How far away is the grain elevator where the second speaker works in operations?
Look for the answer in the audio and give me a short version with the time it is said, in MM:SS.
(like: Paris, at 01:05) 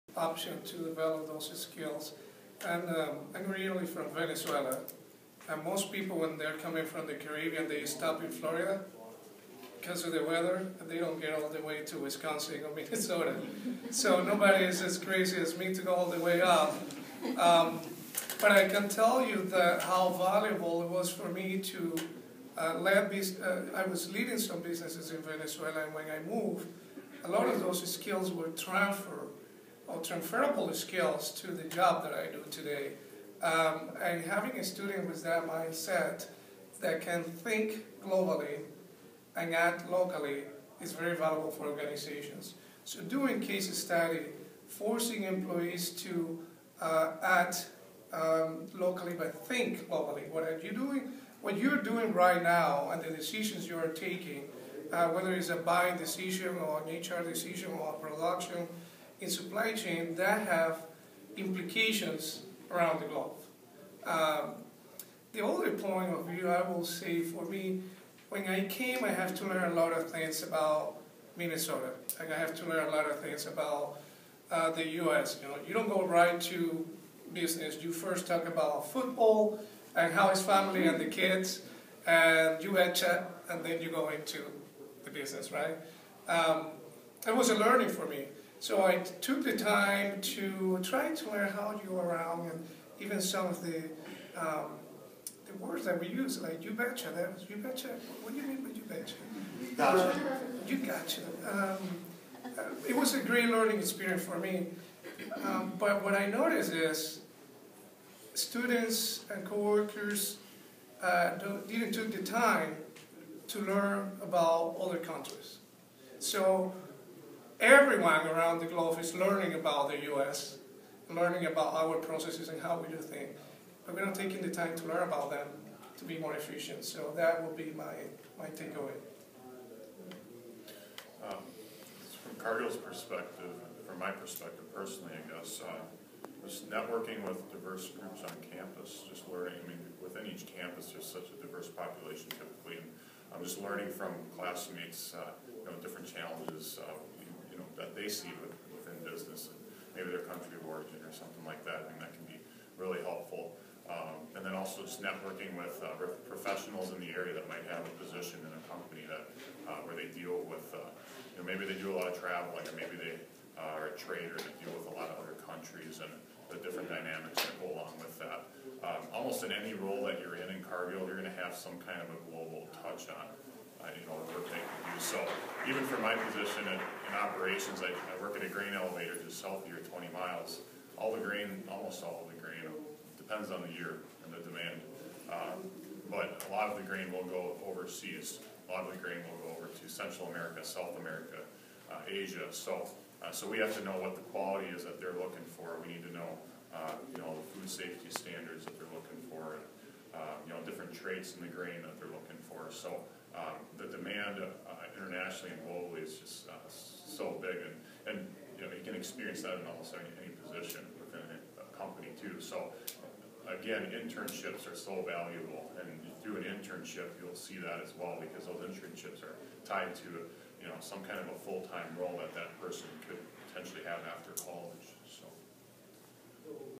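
20 miles, at 02:59.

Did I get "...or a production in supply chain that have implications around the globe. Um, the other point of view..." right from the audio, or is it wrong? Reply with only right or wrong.
right.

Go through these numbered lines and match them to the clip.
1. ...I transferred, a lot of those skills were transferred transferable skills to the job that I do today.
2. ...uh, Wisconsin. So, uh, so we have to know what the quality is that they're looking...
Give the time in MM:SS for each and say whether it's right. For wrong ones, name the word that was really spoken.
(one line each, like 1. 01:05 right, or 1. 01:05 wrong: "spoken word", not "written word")
1. 00:26 wrong: "moved", not "transferred"
2. 03:11 wrong: "Asia", not "Wisconsin".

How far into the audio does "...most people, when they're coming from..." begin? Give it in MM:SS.
00:05.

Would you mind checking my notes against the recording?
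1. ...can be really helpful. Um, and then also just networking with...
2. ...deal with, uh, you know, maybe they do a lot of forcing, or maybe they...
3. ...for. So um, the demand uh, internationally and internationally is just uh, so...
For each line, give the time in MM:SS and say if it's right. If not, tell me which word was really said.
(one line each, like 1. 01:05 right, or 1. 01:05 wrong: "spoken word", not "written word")
1. 02:32 right
2. 02:40 wrong: "traveling", not "forcing"
3. 03:22 wrong: "globally", not "internationally".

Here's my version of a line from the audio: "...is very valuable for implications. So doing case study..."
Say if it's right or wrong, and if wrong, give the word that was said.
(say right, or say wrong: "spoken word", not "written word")
wrong: "organizations", not "implications".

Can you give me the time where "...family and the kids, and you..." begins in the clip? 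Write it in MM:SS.
01:20.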